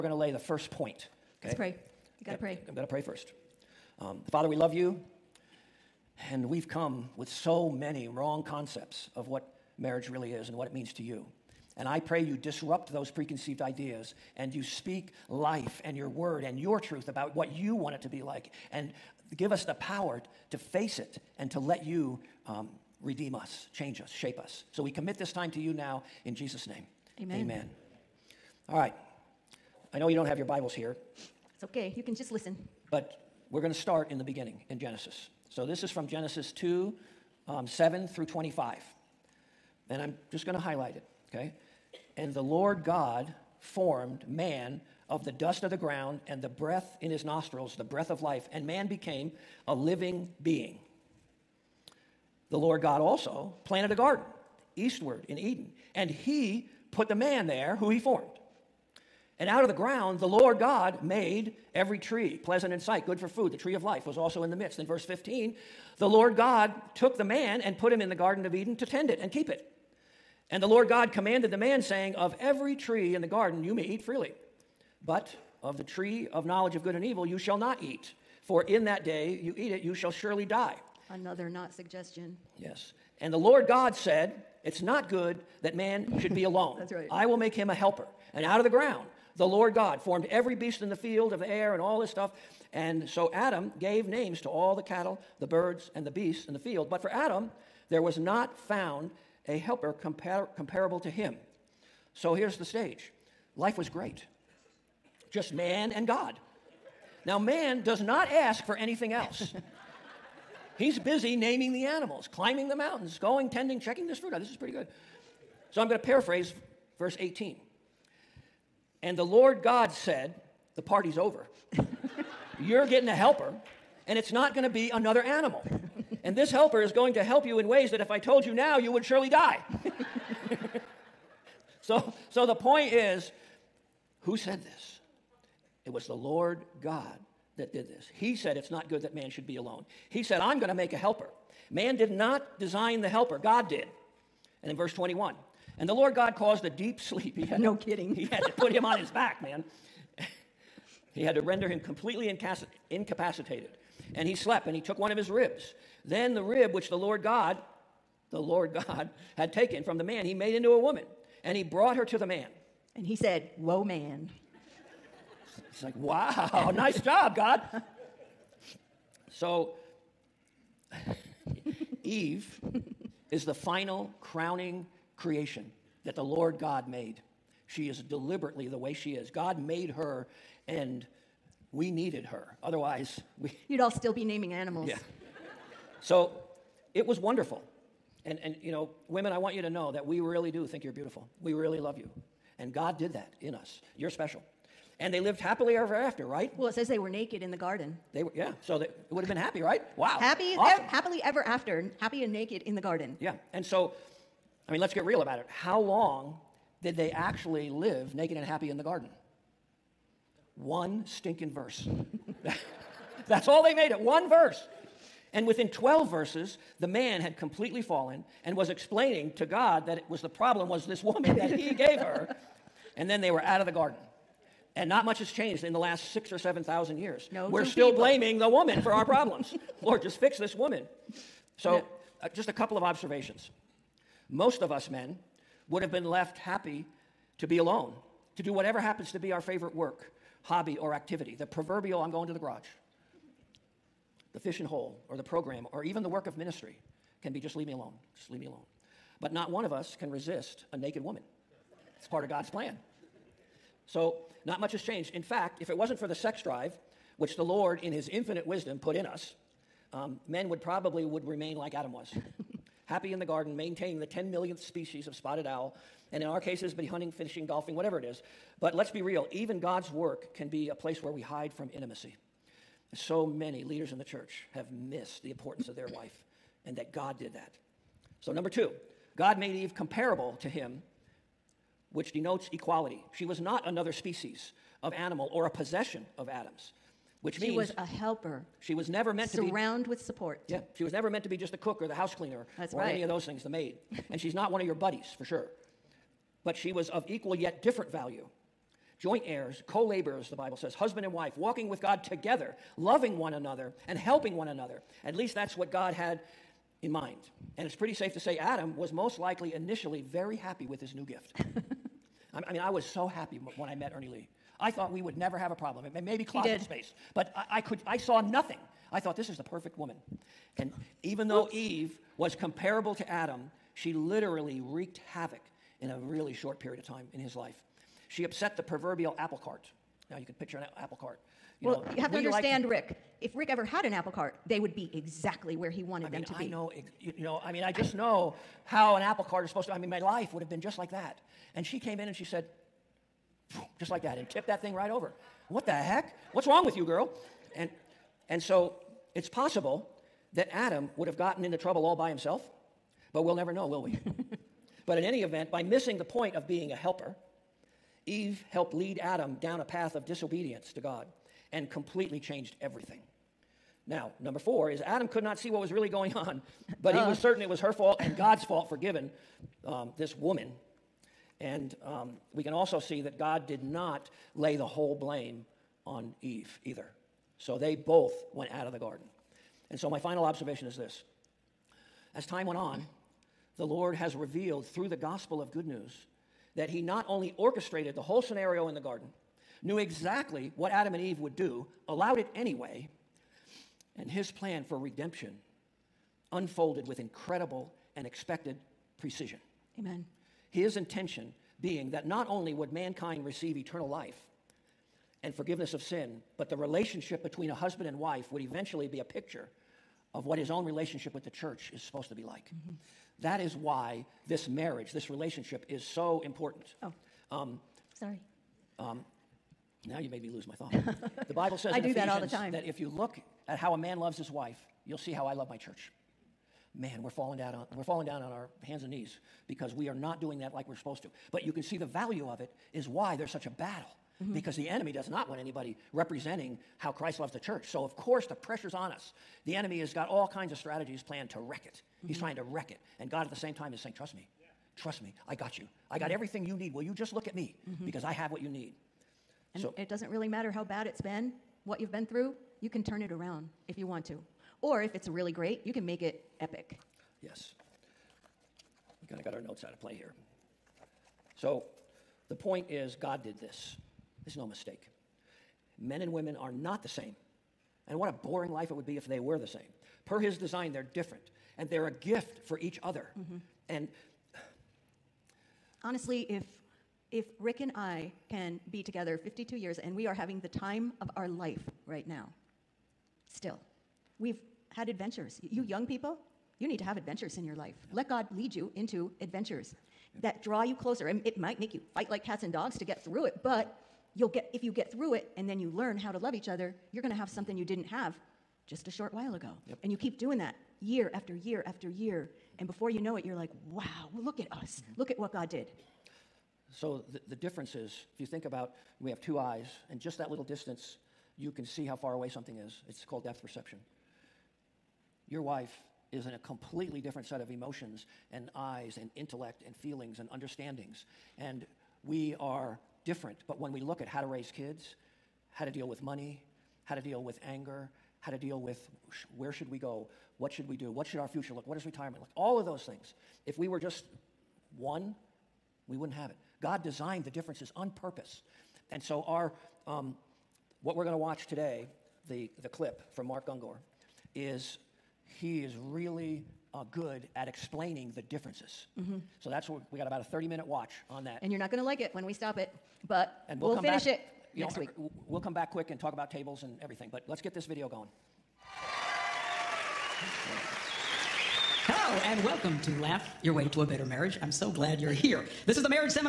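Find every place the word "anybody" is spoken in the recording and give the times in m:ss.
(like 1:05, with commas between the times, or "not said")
7:15.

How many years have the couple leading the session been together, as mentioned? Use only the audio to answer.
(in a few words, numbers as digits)
52.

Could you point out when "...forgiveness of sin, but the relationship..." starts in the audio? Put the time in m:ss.
6:45.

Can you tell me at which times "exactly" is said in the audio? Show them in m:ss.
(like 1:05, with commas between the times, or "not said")
5:34, 6:29.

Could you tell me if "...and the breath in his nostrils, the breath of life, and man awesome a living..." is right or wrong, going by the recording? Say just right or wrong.
wrong.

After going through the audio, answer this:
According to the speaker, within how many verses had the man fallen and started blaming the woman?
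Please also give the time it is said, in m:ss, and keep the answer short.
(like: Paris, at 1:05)
12, at 3:35.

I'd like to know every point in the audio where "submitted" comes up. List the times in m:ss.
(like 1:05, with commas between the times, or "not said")
not said.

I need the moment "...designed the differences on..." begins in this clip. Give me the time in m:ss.
8:56.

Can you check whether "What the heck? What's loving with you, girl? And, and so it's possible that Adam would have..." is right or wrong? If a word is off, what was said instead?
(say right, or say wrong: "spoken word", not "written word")
wrong: "wrong", not "loving".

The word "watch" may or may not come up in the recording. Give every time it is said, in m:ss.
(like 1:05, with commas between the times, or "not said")
9:01, 9:10.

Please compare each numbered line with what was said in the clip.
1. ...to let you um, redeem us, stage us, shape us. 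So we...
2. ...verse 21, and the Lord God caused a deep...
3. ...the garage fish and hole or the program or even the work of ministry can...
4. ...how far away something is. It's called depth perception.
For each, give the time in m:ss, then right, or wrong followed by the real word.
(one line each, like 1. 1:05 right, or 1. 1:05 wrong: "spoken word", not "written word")
1. 0:21 wrong: "change", not "stage"
2. 2:24 right
3. 4:02 right
4. 8:31 right.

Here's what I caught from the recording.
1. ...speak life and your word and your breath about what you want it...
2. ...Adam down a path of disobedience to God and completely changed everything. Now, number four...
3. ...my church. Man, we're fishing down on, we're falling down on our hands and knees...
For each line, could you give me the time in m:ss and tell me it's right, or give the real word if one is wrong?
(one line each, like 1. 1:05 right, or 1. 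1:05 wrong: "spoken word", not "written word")
1. 0:14 wrong: "truth", not "breath"
2. 5:58 right
3. 7:05 wrong: "falling", not "fishing".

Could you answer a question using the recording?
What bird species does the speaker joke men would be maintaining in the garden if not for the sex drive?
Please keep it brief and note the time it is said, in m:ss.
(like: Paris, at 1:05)
spotted owl, at 4:25.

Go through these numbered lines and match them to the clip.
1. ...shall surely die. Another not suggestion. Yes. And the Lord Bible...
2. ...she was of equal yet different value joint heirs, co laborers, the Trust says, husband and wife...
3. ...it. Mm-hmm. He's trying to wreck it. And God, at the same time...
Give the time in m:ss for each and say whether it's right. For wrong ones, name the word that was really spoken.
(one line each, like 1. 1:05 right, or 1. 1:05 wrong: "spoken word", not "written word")
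1. 1:19 wrong: "God", not "Bible"
2. 4:56 wrong: "Bible", not "Trust"
3. 7:21 right.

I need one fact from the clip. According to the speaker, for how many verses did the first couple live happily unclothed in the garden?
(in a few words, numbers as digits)
1.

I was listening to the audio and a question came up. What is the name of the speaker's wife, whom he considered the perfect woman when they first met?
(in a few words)
Ernie Lee.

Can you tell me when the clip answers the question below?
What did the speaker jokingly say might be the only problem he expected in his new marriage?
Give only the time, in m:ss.
5:16.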